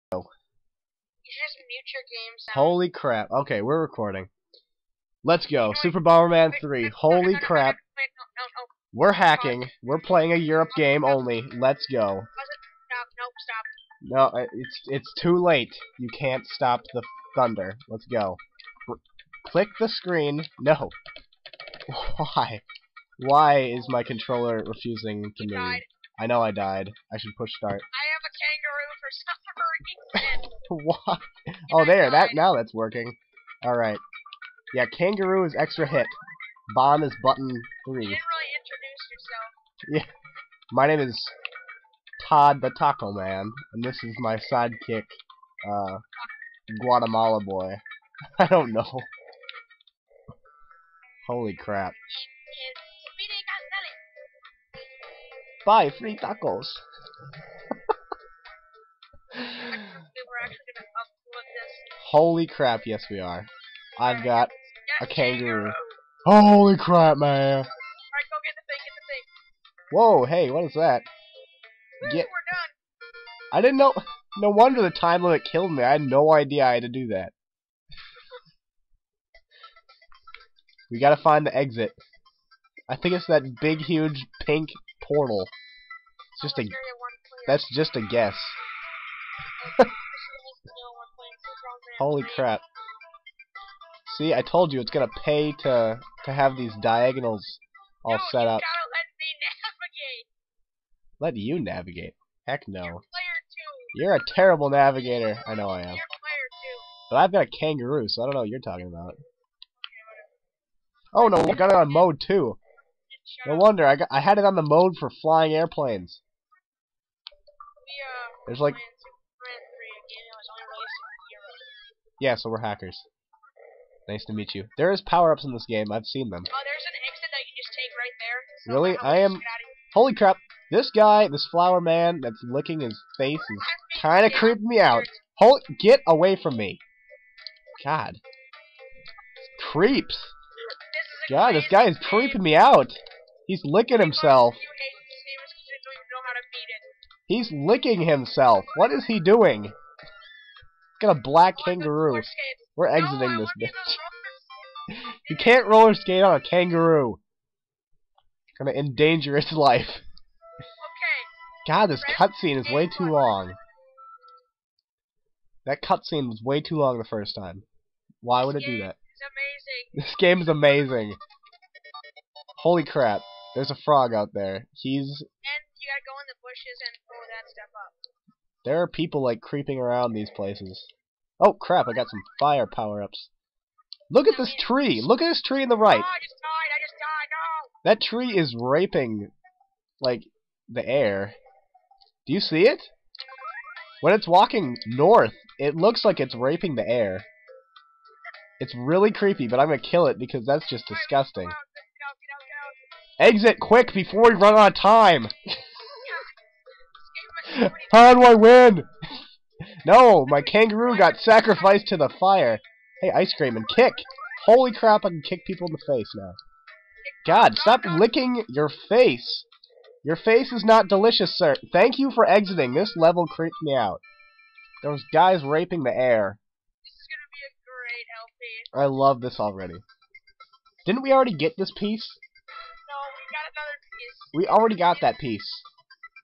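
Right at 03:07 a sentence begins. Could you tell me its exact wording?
That tree is raping, like, the air.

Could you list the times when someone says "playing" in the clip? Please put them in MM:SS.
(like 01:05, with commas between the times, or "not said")
00:10.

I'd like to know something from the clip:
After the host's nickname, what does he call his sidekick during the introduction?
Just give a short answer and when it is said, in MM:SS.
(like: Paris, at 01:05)
Guatemala boy, at 00:46.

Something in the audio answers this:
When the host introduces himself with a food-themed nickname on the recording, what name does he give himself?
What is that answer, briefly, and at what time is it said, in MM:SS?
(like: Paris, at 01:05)
Todd the Taco Man, at 00:42.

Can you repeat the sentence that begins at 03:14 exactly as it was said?
When it's walking north, it looks like it's raping the air.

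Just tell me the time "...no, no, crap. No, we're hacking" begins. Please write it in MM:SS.
00:07.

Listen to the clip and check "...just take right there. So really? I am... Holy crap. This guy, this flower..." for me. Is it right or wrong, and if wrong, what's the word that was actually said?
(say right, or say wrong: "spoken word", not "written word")
right.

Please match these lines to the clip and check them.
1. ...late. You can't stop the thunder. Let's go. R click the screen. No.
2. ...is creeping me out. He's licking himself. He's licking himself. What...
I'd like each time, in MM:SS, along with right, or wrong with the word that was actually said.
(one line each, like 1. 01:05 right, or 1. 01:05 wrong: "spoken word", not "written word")
1. 00:15 right
2. 02:21 right.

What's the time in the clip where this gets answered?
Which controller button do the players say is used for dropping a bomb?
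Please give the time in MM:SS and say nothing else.
00:37.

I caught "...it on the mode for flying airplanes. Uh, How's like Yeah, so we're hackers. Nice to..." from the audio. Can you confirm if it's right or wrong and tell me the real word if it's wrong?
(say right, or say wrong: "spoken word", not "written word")
wrong: "There", not "How".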